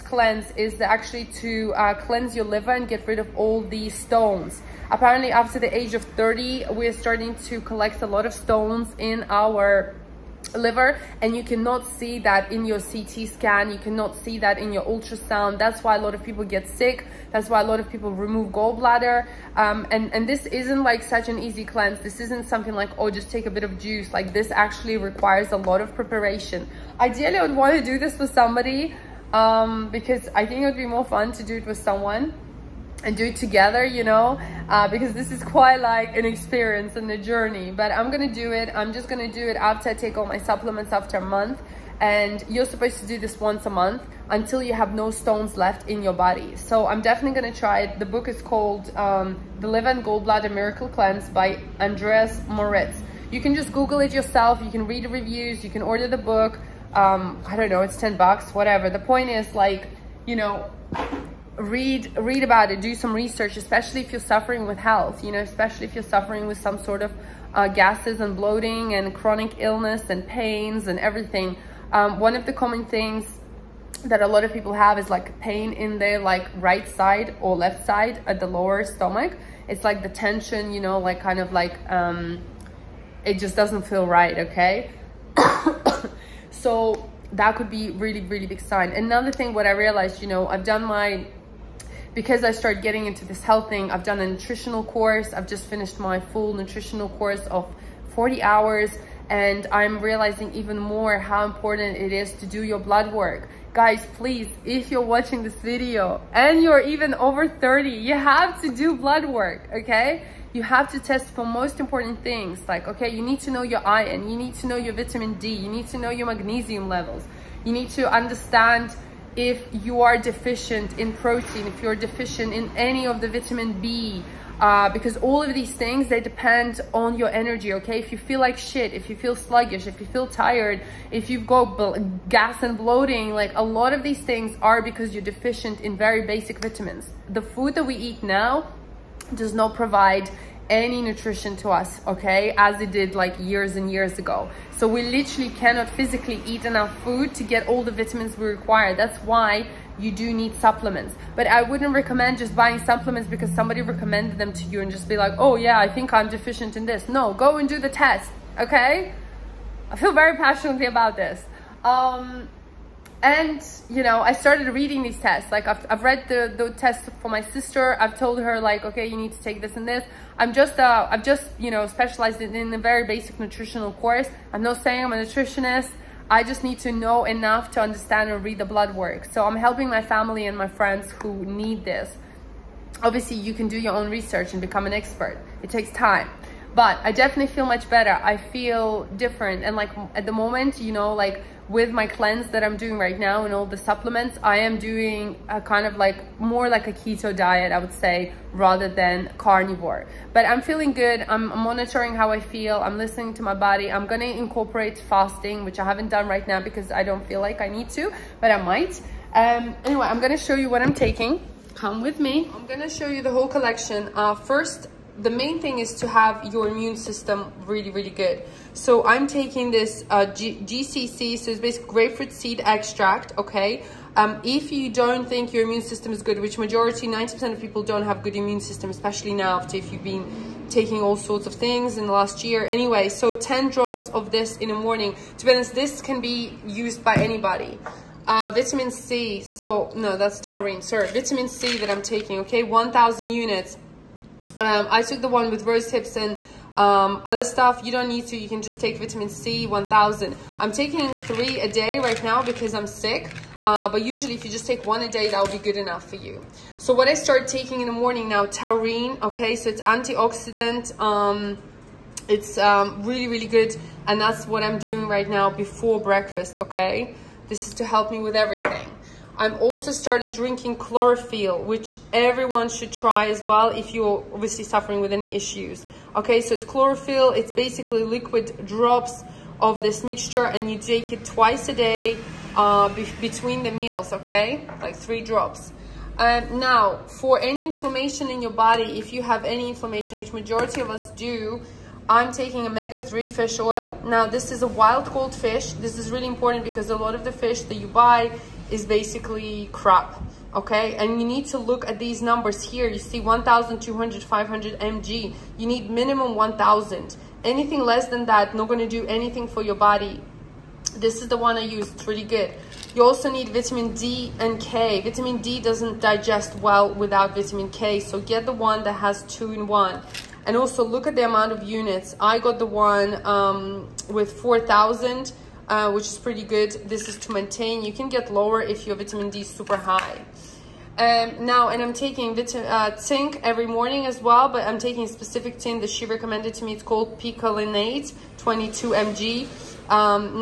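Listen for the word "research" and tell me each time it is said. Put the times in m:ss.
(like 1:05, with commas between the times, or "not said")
1:03, 3:04.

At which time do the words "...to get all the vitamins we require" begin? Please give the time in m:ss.
2:27.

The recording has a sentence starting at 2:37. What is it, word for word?
No, go and do the test, okay?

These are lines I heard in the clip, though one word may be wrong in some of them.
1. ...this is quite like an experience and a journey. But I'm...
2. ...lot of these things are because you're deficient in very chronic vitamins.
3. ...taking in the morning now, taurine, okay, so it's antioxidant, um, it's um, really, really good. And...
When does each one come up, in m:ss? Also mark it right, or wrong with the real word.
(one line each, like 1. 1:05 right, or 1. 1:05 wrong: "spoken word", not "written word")
1. 0:35 right
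2. 2:13 wrong: "basic", not "chronic"
3. 4:17 right.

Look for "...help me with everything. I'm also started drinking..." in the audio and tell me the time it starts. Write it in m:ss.
4:27.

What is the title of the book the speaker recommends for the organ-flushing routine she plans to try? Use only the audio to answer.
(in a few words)
The Liver and Gallbladder Miracle Cleanse.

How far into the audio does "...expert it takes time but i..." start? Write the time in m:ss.
3:04.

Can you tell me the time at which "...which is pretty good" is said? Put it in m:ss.
5:25.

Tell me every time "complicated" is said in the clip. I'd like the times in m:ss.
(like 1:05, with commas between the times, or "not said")
not said.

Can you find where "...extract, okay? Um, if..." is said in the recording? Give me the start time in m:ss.
3:42.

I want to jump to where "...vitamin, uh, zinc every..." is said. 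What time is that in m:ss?
5:32.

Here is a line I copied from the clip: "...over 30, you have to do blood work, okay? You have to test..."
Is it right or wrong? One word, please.
right.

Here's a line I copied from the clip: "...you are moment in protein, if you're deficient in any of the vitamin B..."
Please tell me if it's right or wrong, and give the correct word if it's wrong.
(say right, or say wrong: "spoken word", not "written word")
wrong: "deficient", not "moment".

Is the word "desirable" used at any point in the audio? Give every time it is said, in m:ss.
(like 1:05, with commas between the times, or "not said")
not said.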